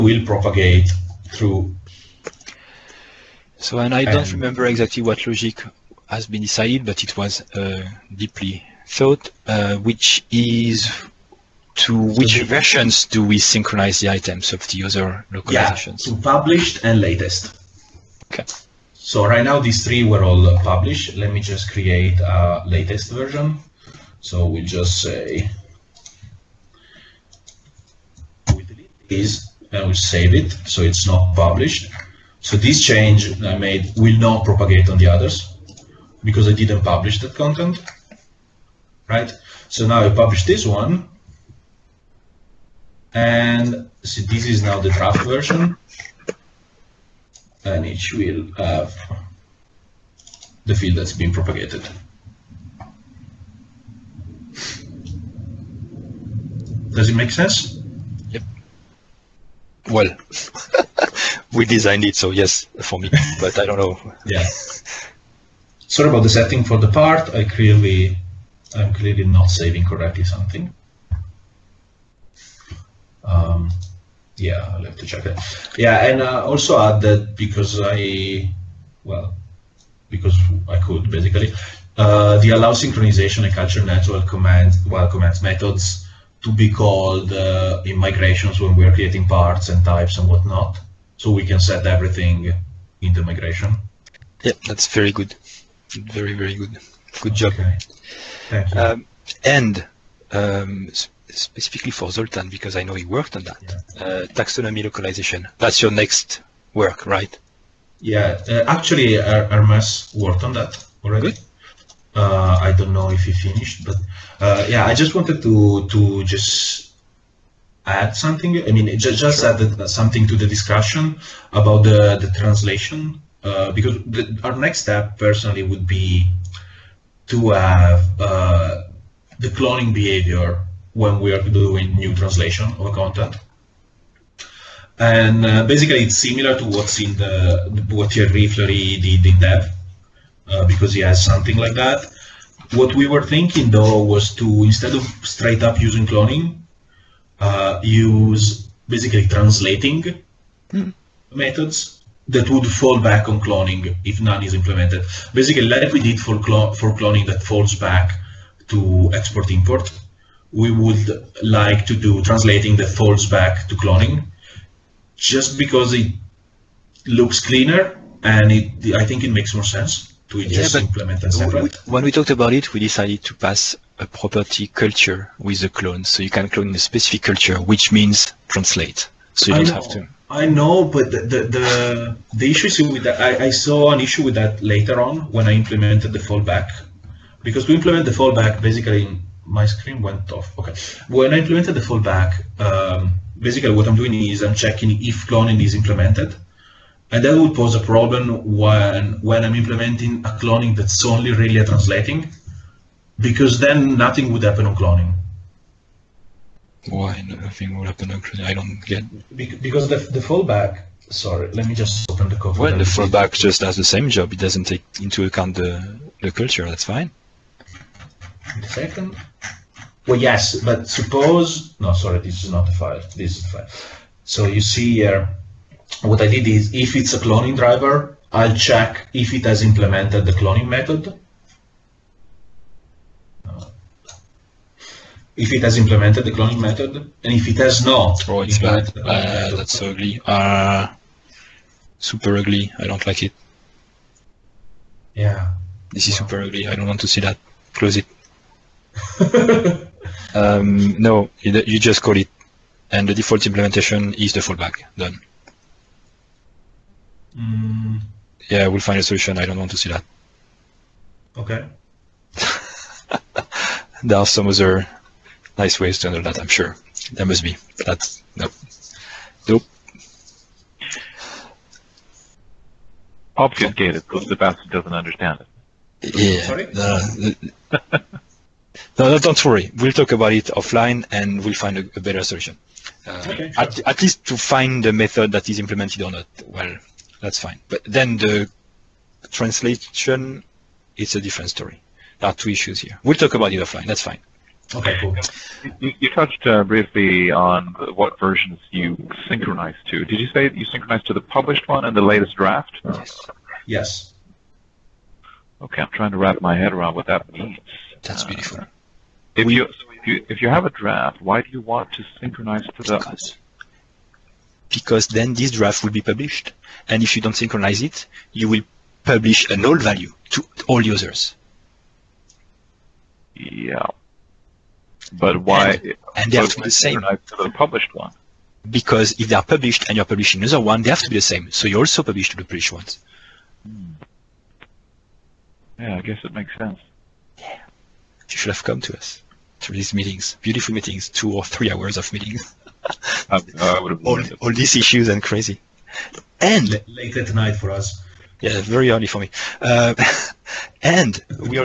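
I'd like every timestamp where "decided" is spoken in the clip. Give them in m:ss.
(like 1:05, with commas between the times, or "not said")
0:06, 2:52.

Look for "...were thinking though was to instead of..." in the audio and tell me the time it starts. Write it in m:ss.
2:23.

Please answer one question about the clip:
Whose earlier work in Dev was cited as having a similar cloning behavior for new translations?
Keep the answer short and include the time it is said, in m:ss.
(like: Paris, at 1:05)
Thierry Fleury, at 2:18.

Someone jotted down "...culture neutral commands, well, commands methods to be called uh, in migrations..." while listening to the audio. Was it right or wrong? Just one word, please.
right.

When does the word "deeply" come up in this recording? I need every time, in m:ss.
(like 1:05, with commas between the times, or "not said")
0:08.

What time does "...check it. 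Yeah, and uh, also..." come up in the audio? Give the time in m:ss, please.
1:15.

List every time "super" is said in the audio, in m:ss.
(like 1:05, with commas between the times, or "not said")
4:01, 4:06.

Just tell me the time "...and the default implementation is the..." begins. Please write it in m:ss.
4:12.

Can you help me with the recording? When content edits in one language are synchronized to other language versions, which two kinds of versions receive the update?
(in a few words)
published and latest.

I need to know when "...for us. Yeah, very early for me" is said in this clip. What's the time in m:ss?
5:47.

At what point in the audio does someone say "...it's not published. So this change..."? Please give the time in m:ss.
0:30.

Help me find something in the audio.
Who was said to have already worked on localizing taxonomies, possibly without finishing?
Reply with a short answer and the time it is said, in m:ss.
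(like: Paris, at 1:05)
Hermes, at 1:49.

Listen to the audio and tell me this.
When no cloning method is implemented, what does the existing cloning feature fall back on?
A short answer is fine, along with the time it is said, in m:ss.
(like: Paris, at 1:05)
export import, at 2:39.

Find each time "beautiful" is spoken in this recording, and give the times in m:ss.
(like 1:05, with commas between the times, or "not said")
5:08, 5:40.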